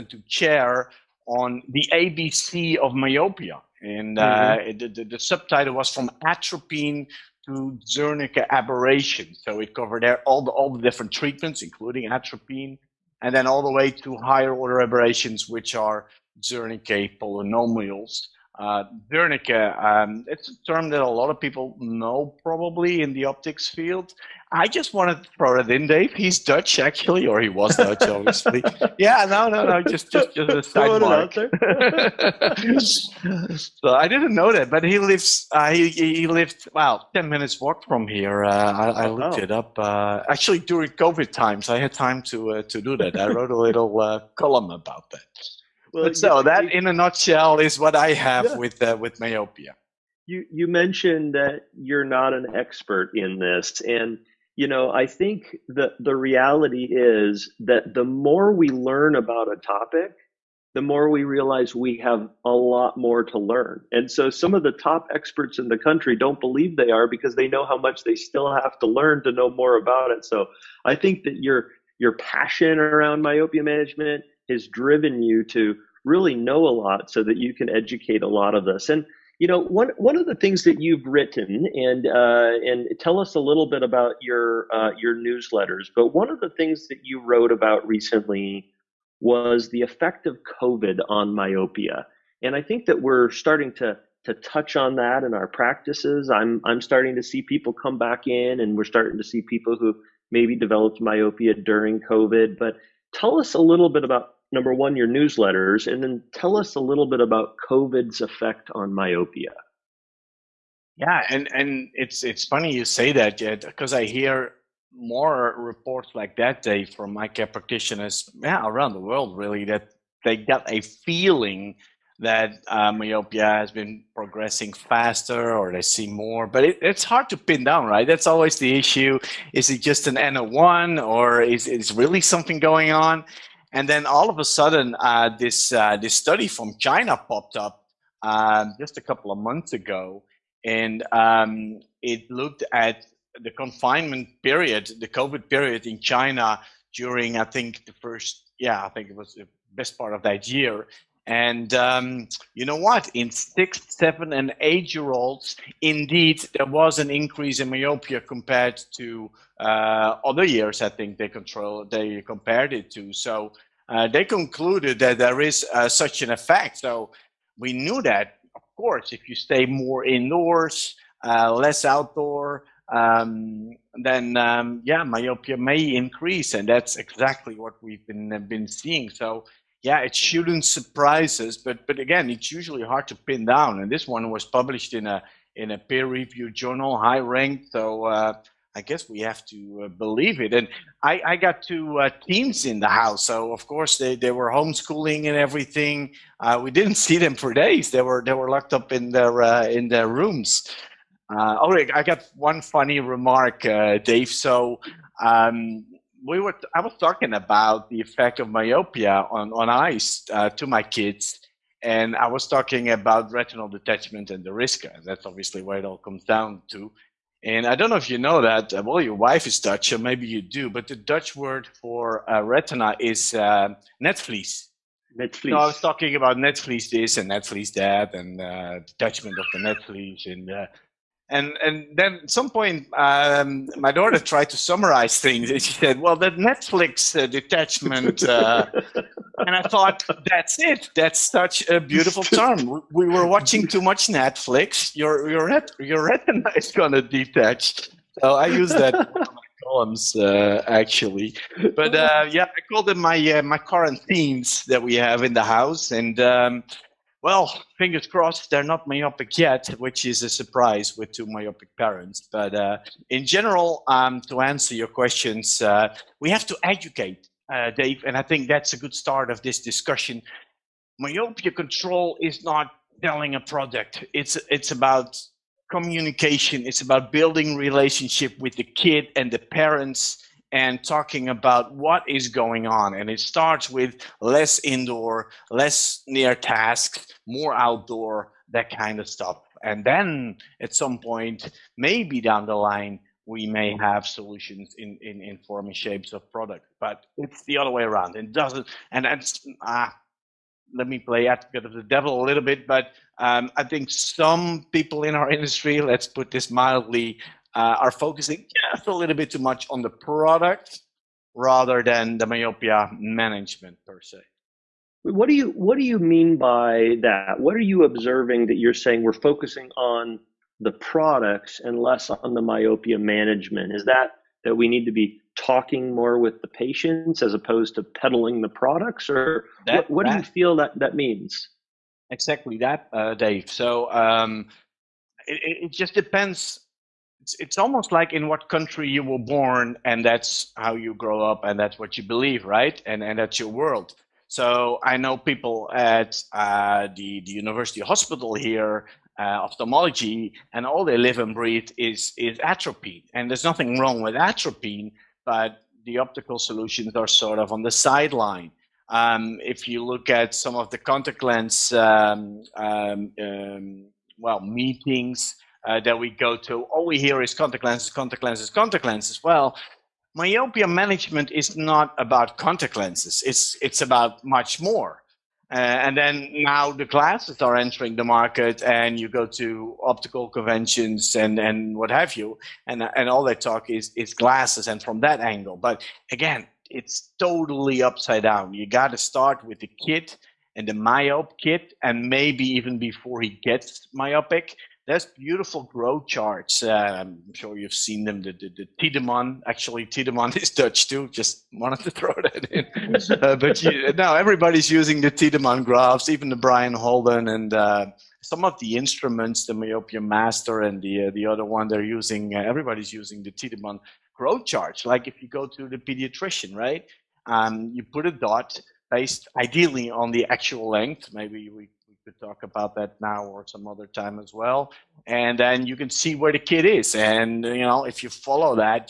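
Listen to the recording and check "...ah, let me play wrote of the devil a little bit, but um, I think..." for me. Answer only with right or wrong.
wrong.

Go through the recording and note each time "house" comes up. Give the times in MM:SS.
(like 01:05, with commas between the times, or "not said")
03:12, 04:15.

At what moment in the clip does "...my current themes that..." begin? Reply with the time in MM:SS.
04:13.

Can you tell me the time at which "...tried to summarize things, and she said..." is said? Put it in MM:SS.
03:54.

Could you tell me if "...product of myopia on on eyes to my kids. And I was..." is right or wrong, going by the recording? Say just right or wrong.
wrong.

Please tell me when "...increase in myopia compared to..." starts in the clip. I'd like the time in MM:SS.
02:37.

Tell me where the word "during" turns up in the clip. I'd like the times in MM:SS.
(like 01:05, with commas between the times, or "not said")
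00:40, 01:41, 02:26.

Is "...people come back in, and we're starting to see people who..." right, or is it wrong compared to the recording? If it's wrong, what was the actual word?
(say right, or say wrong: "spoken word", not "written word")
right.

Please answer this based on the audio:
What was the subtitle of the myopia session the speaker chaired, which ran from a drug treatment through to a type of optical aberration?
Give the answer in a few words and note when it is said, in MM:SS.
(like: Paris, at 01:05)
From Atropine to Zernike aberration, at 00:05.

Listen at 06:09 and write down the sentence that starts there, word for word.
Well, myopia management is not about contact lenses.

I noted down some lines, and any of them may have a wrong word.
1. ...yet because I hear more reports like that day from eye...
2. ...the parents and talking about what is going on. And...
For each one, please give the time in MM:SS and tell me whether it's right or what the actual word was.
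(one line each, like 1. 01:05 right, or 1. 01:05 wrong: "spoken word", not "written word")
1. 01:53 right
2. 04:39 right.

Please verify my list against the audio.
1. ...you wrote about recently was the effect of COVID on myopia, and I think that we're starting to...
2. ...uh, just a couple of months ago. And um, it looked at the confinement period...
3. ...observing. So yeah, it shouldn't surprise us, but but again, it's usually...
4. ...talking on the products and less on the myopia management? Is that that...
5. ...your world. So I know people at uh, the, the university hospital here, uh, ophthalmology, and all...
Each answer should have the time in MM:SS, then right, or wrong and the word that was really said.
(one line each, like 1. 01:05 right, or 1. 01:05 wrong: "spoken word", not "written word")
1. 01:27 right
2. 02:18 right
3. 02:58 wrong: "seeing", not "observing"
4. 05:19 wrong: "focusing", not "talking"
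5. 05:43 right.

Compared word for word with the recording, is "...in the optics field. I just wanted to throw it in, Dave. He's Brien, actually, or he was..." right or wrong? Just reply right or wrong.
wrong.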